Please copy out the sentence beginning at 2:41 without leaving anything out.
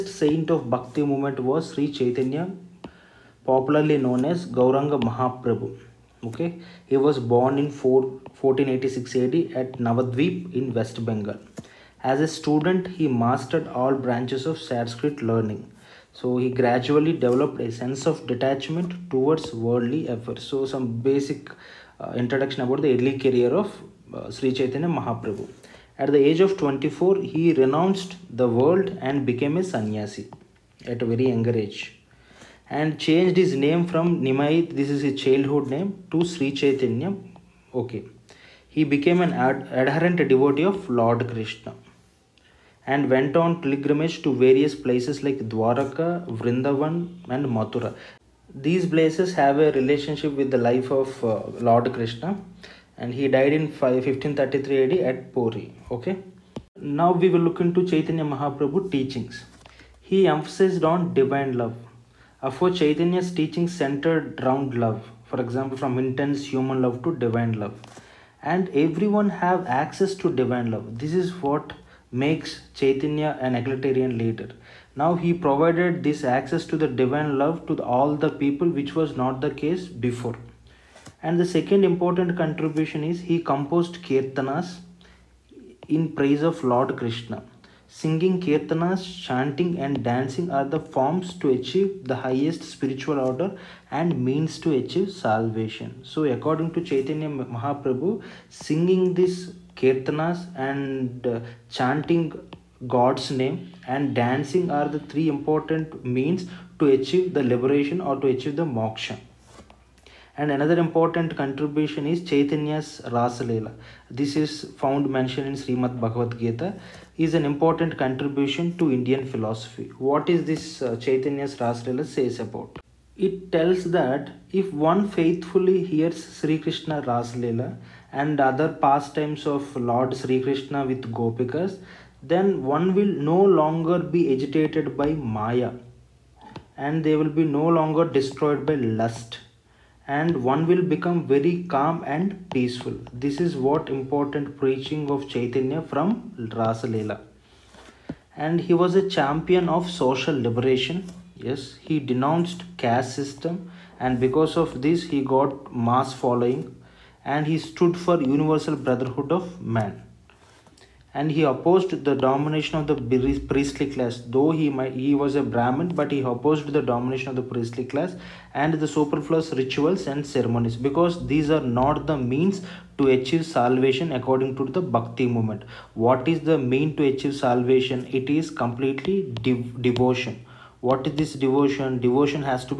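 And he opposed the domination of the priestly class.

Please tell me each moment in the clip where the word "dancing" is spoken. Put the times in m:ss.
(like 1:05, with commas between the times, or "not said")
1:30, 1:44.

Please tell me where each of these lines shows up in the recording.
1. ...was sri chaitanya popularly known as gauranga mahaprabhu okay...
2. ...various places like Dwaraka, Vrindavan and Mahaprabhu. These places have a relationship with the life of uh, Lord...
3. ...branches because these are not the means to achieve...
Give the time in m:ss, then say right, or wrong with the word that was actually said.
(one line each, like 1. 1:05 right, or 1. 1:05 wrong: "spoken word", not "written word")
1. 0:01 right
2. 0:44 wrong: "Mathura", not "Mahaprabhu"
3. 2:50 wrong: "ceremonies", not "branches".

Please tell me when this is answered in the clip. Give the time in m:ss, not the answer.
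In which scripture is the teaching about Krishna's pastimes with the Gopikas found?
1:55.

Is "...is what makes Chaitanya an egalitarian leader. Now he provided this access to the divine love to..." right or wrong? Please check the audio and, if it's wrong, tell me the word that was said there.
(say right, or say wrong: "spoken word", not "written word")
right.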